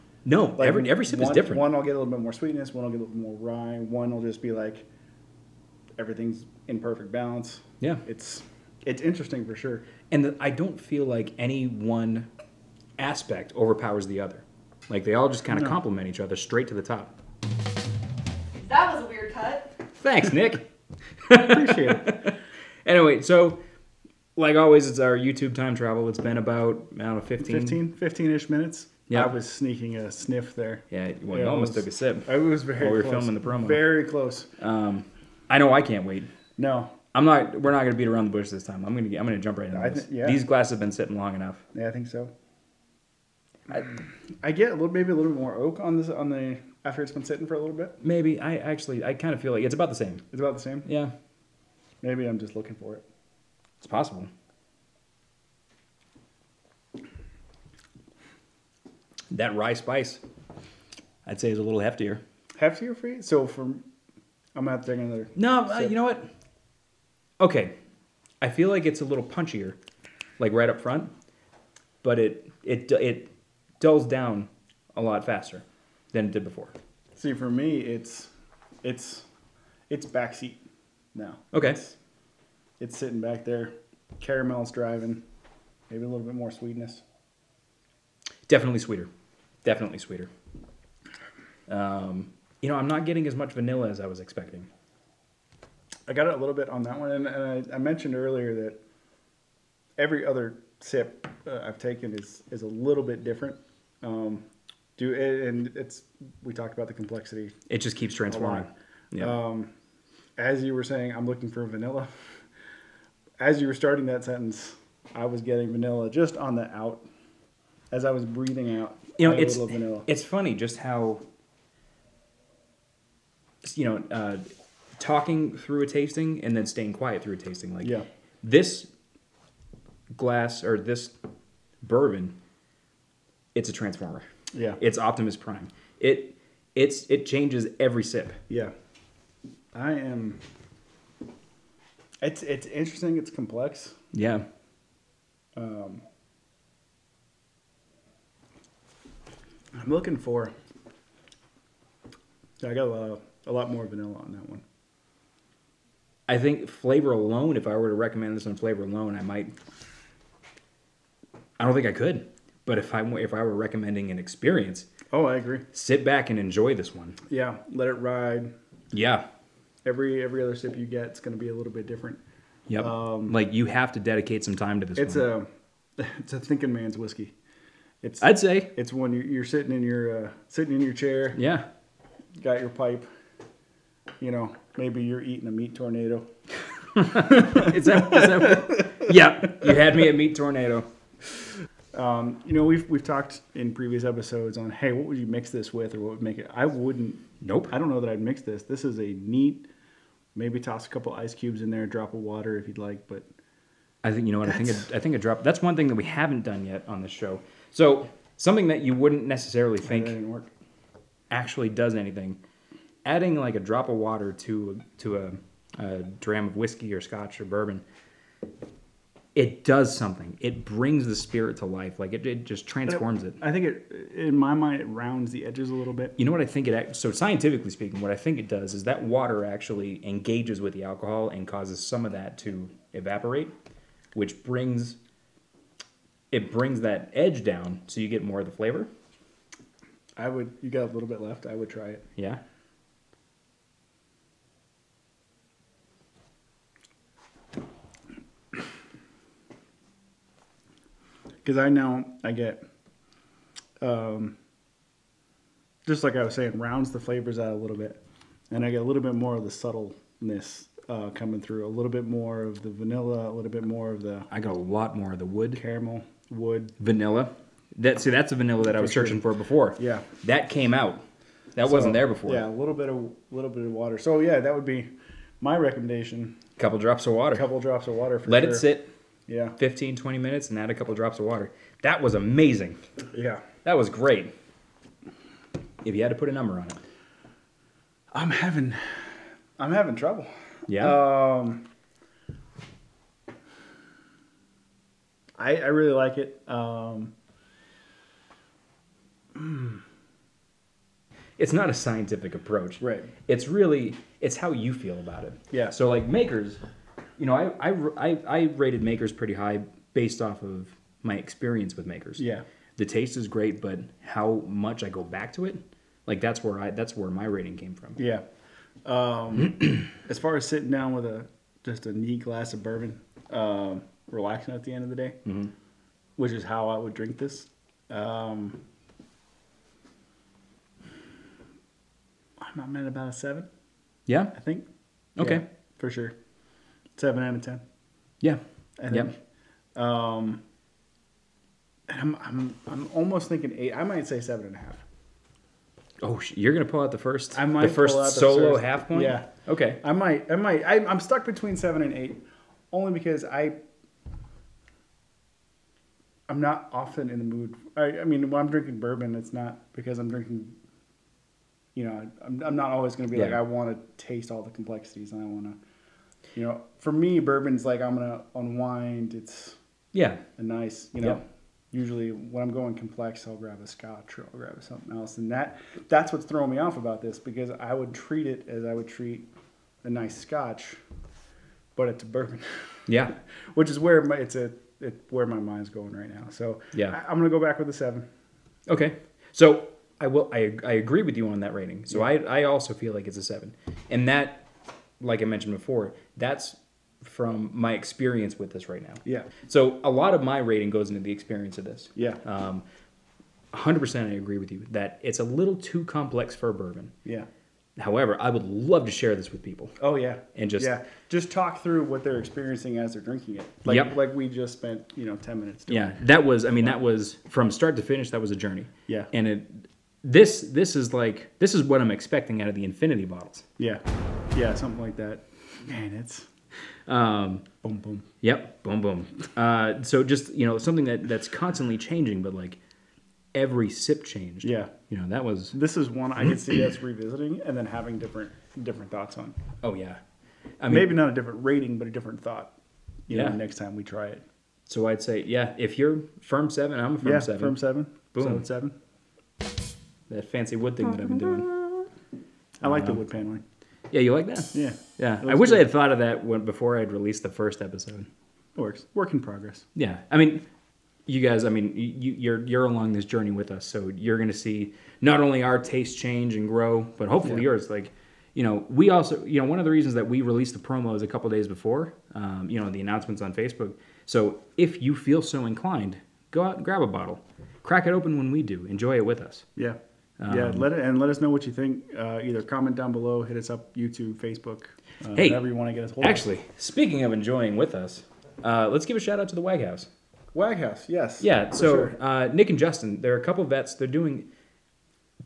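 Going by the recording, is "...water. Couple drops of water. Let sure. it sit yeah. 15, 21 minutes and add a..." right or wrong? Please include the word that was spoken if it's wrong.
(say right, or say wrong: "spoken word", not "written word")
wrong: "20", not "21".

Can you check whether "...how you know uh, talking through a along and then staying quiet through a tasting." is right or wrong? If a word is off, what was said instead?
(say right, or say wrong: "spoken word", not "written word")
wrong: "tasting", not "along".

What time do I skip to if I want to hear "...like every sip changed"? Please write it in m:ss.
7:12.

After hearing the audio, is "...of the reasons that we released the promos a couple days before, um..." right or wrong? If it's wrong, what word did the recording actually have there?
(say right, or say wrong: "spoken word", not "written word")
right.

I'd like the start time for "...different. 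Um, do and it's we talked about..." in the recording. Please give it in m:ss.
1:43.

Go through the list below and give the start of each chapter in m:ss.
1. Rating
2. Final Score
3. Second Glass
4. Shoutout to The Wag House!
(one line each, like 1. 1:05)
1. 4:43
2. 7:22
3. 0:16
4. 8:04.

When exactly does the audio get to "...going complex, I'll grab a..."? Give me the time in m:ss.
6:12.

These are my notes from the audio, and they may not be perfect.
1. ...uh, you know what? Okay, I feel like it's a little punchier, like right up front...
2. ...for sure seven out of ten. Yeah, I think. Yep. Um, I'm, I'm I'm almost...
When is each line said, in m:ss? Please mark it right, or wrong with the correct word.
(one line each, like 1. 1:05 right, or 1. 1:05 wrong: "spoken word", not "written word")
1. 1:05 right
2. 5:35 right.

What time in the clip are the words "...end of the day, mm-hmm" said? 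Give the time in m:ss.
5:24.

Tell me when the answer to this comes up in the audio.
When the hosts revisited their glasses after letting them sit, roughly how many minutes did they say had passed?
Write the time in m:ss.
0:27.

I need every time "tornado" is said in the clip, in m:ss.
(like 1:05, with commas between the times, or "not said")
3:05, 3:10.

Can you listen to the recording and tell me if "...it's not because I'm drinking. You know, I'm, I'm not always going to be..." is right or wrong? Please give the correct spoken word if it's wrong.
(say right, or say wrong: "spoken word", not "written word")
right.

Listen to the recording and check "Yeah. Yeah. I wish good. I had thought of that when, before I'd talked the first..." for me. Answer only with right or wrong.
wrong.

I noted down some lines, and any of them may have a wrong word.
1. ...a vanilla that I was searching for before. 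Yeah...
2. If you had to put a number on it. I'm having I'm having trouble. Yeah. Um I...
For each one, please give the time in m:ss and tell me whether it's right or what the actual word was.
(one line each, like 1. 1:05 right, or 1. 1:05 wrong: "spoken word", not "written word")
1. 4:28 right
2. 4:45 right.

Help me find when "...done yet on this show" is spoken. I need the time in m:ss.
3:26.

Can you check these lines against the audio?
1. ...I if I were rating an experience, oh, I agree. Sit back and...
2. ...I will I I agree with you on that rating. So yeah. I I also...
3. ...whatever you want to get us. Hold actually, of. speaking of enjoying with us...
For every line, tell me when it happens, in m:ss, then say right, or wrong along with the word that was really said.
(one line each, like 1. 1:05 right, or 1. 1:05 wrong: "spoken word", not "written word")
1. 2:42 wrong: "recommending", not "rating"
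2. 6:29 right
3. 8:05 right.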